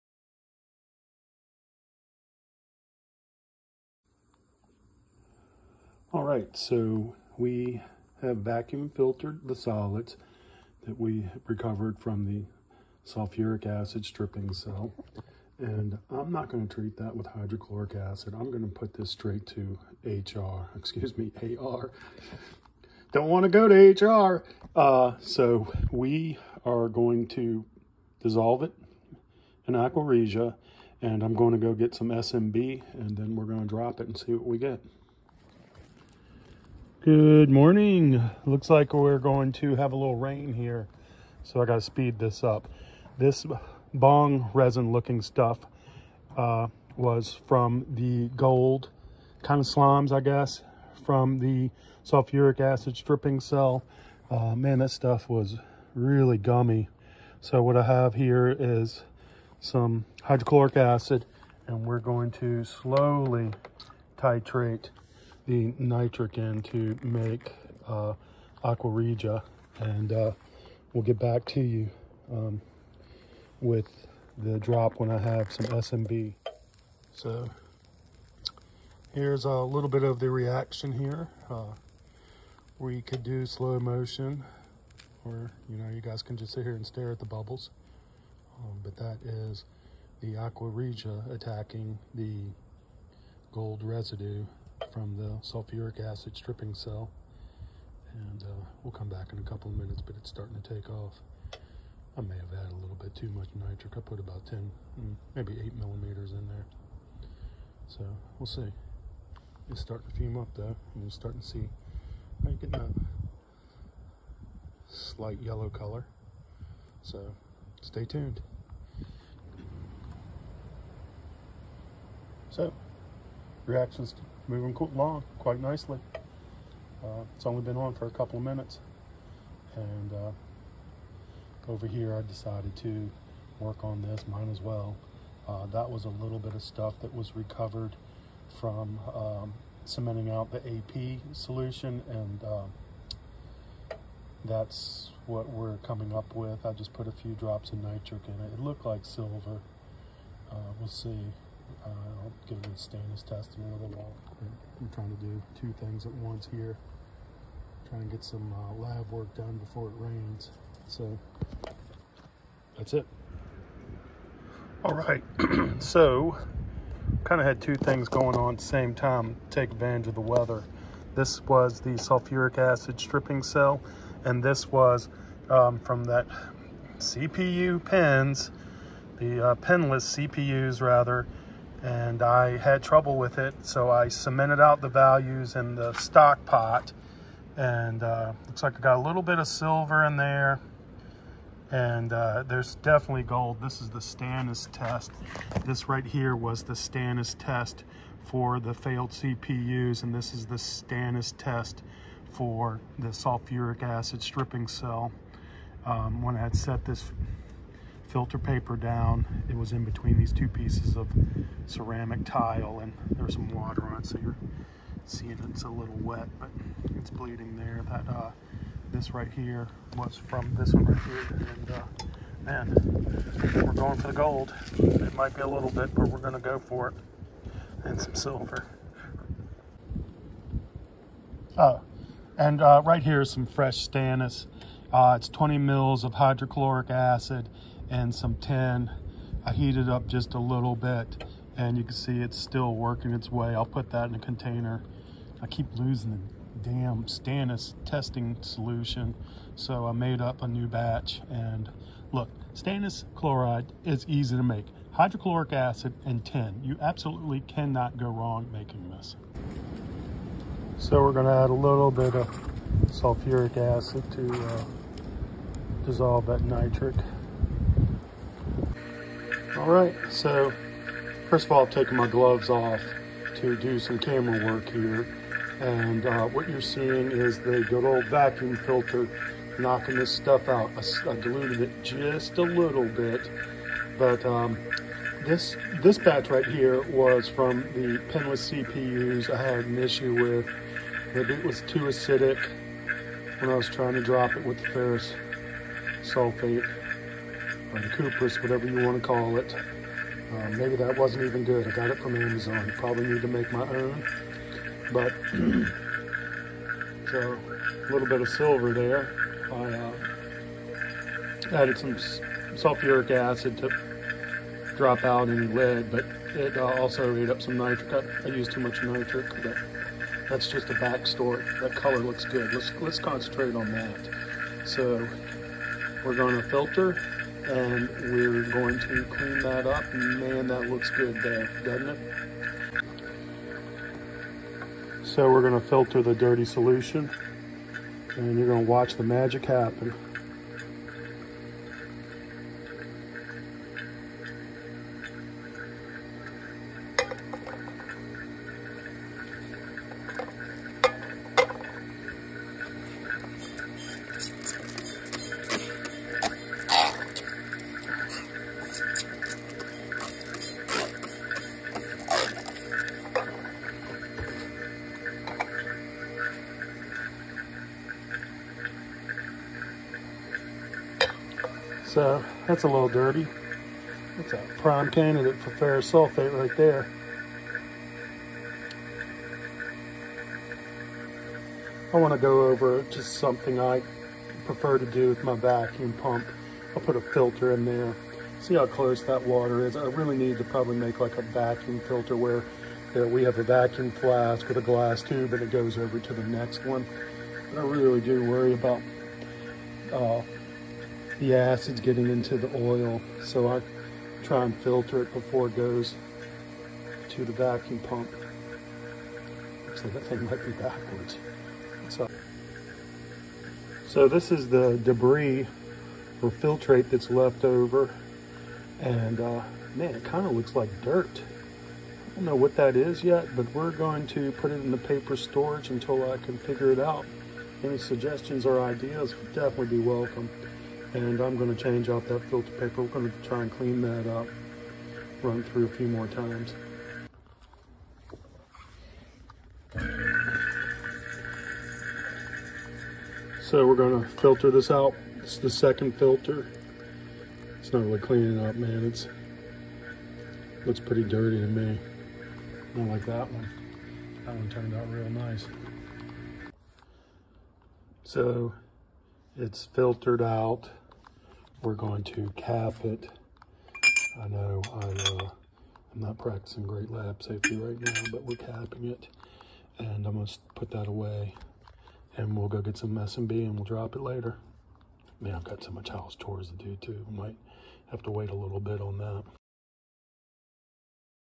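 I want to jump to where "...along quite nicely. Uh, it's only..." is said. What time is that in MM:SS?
02:04.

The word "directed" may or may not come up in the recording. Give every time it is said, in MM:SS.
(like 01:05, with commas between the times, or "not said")
not said.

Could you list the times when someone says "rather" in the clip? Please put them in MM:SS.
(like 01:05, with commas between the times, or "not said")
03:00.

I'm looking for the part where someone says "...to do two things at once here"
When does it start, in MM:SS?
02:35.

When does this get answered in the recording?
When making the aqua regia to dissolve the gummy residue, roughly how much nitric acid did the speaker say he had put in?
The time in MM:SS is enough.
01:45.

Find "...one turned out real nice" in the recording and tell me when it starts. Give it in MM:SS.
07:34.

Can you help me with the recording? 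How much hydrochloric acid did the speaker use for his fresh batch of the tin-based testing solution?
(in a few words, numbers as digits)
20 mils.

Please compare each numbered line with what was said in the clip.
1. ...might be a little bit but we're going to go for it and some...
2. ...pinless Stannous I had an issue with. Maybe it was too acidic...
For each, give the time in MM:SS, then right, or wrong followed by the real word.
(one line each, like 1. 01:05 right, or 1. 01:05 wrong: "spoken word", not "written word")
1. 03:45 right
2. 04:48 wrong: "CPUs", not "Stannous".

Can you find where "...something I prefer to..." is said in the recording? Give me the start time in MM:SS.
06:23.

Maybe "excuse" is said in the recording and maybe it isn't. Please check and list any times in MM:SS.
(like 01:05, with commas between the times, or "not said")
00:20.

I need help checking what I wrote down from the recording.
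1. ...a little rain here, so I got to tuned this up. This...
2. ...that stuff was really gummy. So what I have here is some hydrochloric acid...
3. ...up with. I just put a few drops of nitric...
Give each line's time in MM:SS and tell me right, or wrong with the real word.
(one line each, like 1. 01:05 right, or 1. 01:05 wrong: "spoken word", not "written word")
1. 00:39 wrong: "speed", not "tuned"
2. 00:54 right
3. 02:26 right.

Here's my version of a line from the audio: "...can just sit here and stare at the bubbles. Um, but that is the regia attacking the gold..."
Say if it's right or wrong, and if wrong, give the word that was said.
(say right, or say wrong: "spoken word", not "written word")
right.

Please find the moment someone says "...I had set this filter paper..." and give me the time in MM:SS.
03:26.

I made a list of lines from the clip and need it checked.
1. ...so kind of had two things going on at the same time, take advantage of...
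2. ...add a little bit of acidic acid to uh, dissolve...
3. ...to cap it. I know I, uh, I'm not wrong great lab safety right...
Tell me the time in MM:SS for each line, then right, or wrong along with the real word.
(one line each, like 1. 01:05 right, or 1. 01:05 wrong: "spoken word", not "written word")
1. 02:45 right
2. 04:21 wrong: "sulfuric", not "acidic"
3. 07:42 wrong: "practicing", not "wrong".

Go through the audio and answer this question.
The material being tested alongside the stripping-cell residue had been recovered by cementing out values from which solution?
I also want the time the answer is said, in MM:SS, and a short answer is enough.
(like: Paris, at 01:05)
AP solution, at 02:20.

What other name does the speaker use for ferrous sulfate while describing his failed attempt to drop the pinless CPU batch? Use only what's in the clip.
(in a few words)
Cooper's.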